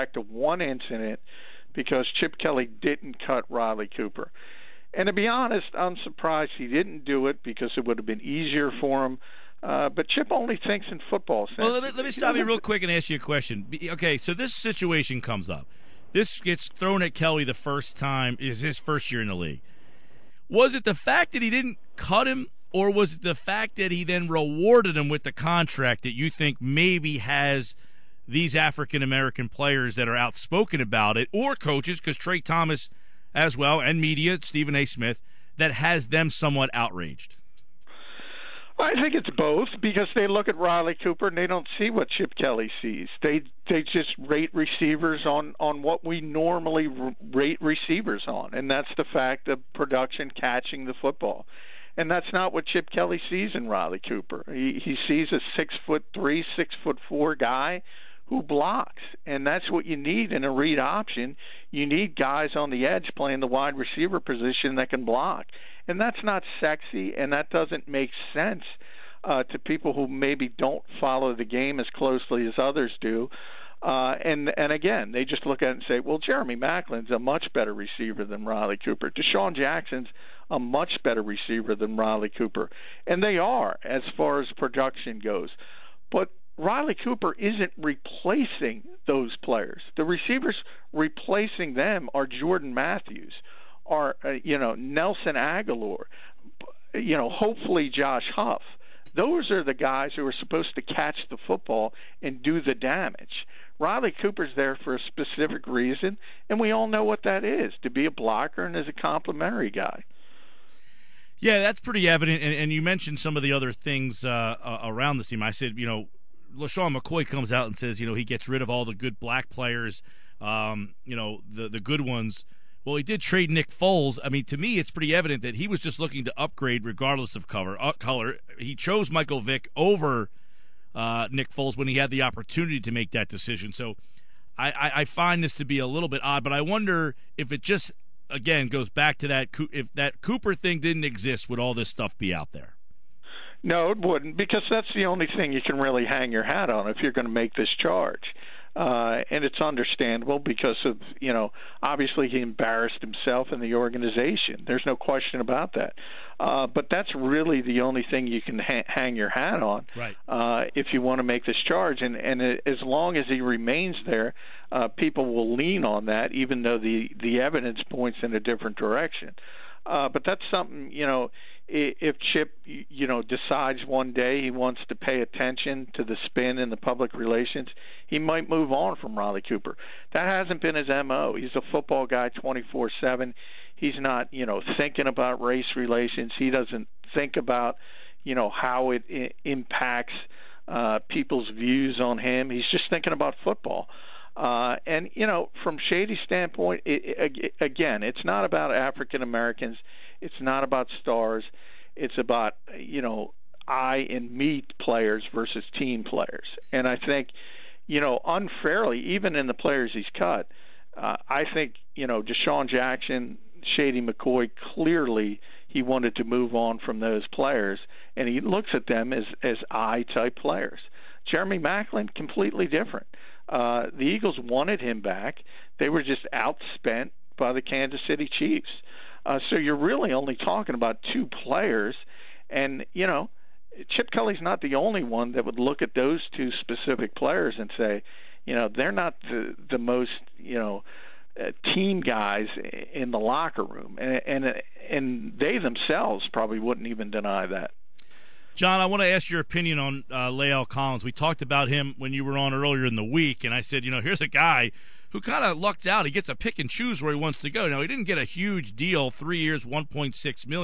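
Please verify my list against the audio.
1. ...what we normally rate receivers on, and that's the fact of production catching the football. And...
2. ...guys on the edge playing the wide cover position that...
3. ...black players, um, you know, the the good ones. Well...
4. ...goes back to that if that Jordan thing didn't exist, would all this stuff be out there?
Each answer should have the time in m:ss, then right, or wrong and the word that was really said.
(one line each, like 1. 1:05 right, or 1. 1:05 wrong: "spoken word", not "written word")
1. 0:45 right
2. 1:02 wrong: "receiver", not "cover"
3. 1:59 right
4. 2:18 wrong: "Cooper", not "Jordan".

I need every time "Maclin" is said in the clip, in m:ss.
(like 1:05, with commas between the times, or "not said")
1:16, 3:41.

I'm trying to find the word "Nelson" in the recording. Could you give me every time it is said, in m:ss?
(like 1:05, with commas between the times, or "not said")
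1:34.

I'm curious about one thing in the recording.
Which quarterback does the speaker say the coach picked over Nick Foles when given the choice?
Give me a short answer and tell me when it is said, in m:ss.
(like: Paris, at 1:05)
Michael Vick, at 2:09.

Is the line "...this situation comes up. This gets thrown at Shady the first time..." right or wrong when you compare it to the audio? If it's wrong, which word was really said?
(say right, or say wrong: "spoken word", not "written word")
wrong: "Kelly", not "Shady".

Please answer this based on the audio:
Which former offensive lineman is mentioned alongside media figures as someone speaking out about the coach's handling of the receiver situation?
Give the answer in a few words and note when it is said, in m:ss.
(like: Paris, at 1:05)
Tra Thomas, at 0:32.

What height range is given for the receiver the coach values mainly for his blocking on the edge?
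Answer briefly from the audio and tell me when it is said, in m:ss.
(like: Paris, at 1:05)
6'3" to 6'4", at 0:55.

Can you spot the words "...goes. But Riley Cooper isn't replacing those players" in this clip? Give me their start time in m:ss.
1:25.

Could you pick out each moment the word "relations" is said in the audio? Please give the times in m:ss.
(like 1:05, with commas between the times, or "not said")
2:57, 3:05.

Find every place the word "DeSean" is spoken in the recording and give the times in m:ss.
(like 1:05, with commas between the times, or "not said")
1:19, 3:32.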